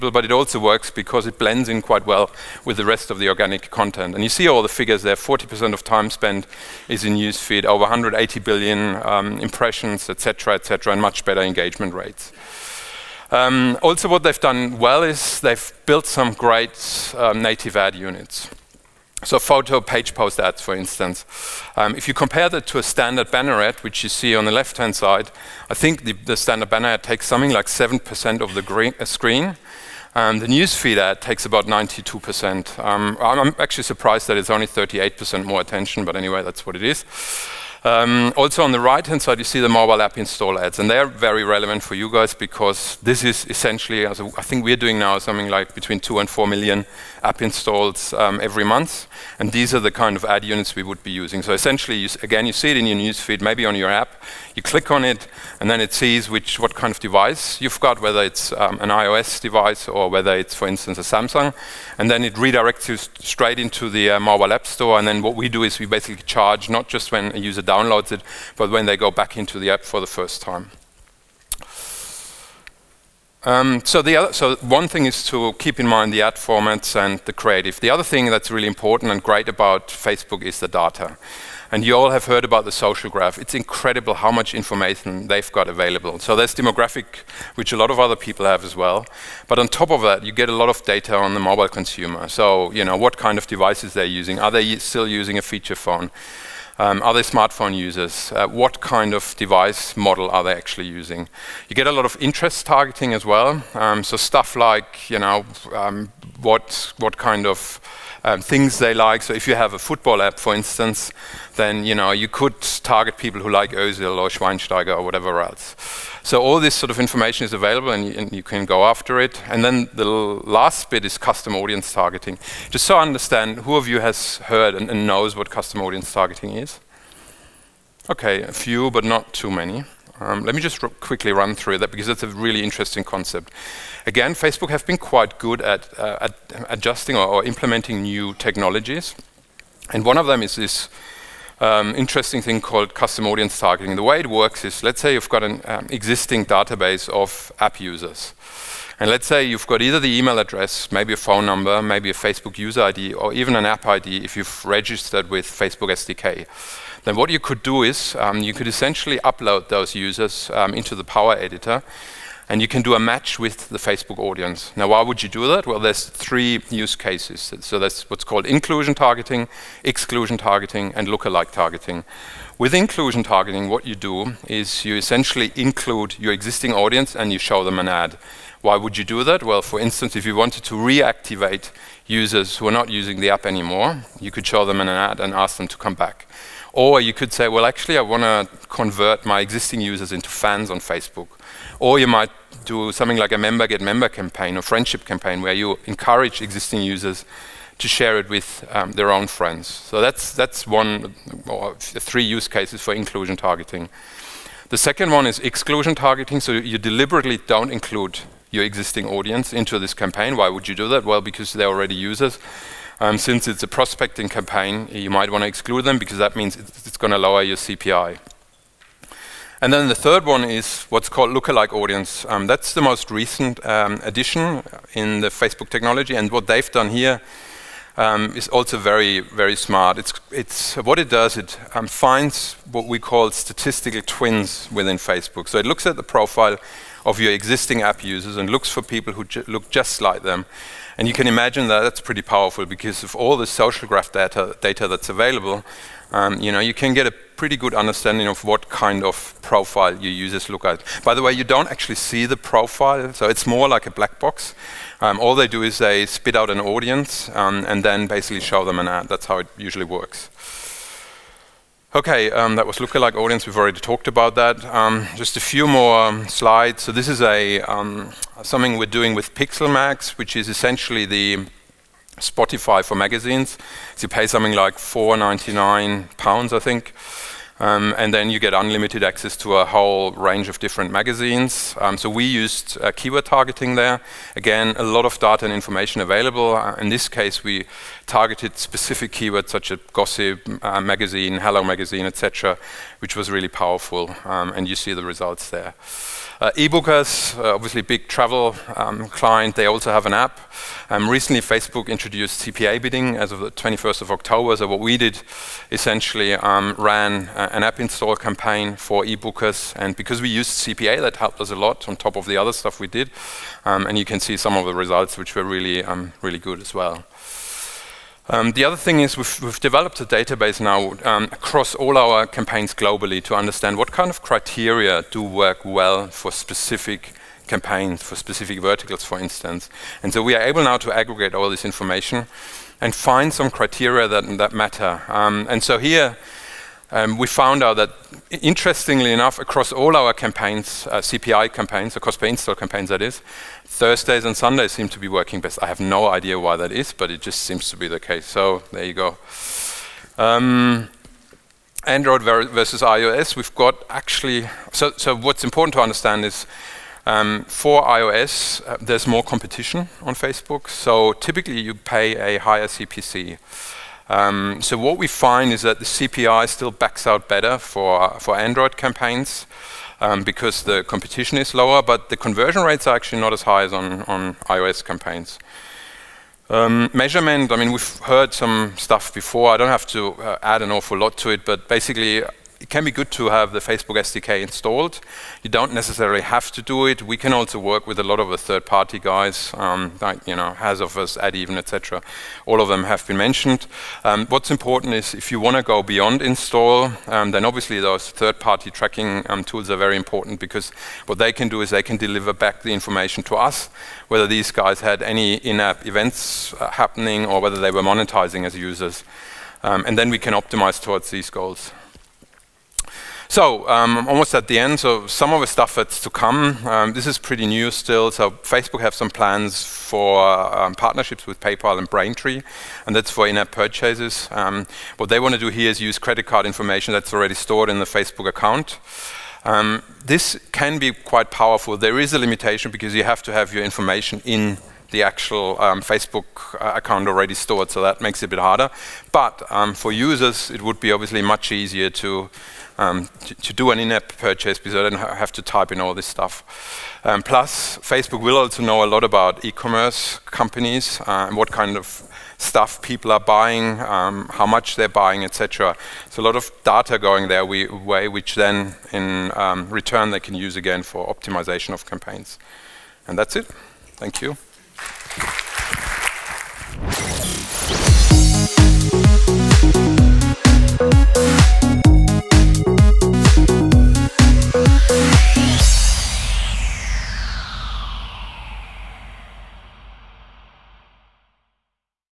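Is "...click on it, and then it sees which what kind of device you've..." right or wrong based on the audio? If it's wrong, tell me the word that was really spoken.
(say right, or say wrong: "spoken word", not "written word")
right.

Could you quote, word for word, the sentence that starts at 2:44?
Now, why would you do that?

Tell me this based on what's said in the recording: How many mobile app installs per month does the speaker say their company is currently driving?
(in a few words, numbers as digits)
2 to 4 million.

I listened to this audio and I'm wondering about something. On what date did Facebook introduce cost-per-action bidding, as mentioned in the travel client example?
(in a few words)
21 October.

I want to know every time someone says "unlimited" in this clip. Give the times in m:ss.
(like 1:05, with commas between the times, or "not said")
4:38.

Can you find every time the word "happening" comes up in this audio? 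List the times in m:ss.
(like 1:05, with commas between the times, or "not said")
6:46.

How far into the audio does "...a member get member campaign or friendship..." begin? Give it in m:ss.
3:13.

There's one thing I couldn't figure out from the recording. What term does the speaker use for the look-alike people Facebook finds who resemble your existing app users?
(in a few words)
statistical twins.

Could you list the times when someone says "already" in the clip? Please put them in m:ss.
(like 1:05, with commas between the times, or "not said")
3:31, 4:23, 7:07, 7:17.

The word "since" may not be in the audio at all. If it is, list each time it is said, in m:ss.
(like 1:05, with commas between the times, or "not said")
3:33.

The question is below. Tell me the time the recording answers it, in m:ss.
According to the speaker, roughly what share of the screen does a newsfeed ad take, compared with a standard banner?
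0:31.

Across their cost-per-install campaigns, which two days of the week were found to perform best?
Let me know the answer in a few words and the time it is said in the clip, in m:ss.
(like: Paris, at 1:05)
Thursdays and Sundays, at 5:43.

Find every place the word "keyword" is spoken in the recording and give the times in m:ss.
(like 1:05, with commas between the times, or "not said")
4:42, 4:49.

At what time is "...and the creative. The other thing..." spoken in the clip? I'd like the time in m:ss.
1:16.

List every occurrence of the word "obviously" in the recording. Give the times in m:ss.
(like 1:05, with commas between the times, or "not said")
4:57, 6:37, 7:20.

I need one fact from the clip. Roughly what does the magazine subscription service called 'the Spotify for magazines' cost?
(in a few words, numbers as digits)
£4.99.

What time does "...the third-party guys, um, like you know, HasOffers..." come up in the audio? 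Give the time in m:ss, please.
6:28.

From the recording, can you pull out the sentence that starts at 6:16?
Um, measurement, I mean, we've heard some stuff before.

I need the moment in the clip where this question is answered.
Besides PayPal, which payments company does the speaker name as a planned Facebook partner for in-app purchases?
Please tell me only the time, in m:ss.
7:01.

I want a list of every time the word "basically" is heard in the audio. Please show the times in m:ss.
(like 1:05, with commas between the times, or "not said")
1:05, 4:18, 6:21.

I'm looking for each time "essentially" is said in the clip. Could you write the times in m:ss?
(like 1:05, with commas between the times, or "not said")
0:43, 0:51, 2:38, 2:54, 4:30, 5:05.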